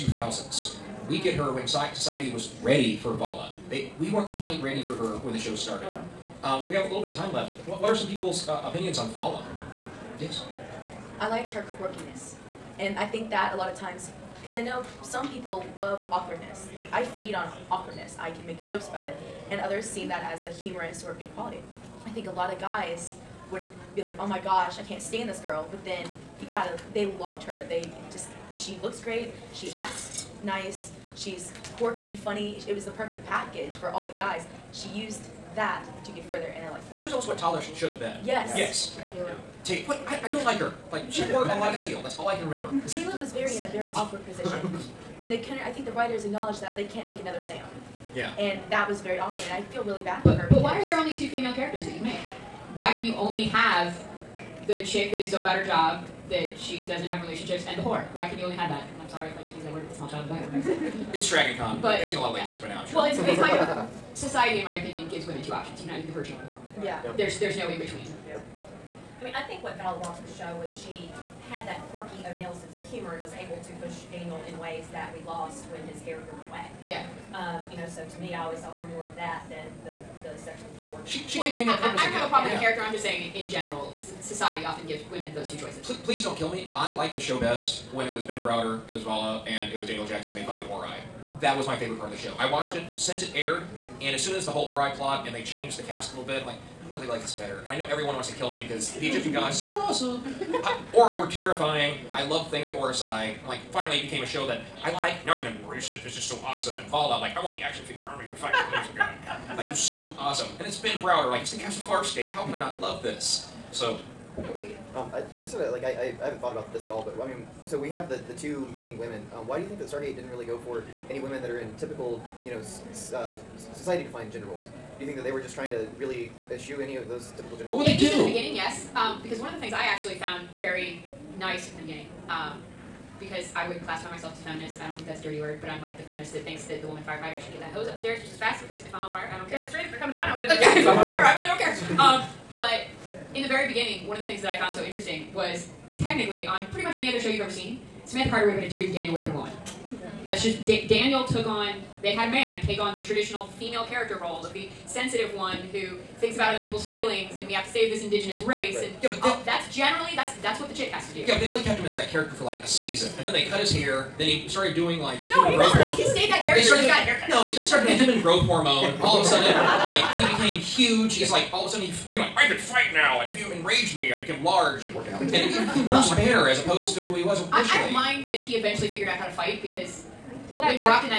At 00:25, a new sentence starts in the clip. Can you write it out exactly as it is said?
But then you gotta, they loved her.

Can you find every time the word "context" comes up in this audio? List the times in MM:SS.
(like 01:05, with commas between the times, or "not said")
not said.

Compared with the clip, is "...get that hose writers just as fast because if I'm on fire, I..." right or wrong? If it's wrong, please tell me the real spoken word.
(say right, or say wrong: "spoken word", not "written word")
wrong: "upstairs", not "writers".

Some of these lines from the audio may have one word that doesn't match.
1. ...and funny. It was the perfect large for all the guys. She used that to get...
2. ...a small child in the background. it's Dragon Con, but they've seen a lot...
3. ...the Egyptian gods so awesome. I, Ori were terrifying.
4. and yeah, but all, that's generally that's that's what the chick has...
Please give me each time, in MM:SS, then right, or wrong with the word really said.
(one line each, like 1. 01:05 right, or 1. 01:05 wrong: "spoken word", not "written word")
1. 00:32 wrong: "package", not "large"
2. 00:59 right
3. 01:38 right
4. 02:38 right.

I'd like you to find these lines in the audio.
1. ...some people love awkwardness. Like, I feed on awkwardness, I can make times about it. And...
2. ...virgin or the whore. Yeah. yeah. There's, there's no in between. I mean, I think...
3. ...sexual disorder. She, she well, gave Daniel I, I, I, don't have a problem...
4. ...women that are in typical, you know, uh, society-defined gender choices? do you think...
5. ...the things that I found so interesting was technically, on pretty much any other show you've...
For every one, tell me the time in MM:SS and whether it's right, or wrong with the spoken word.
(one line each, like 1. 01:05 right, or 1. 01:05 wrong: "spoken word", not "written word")
1. 00:15 wrong: "jokes", not "times"
2. 01:06 right
3. 01:20 right
4. 02:01 wrong: "roles", not "choices"
5. 02:24 right.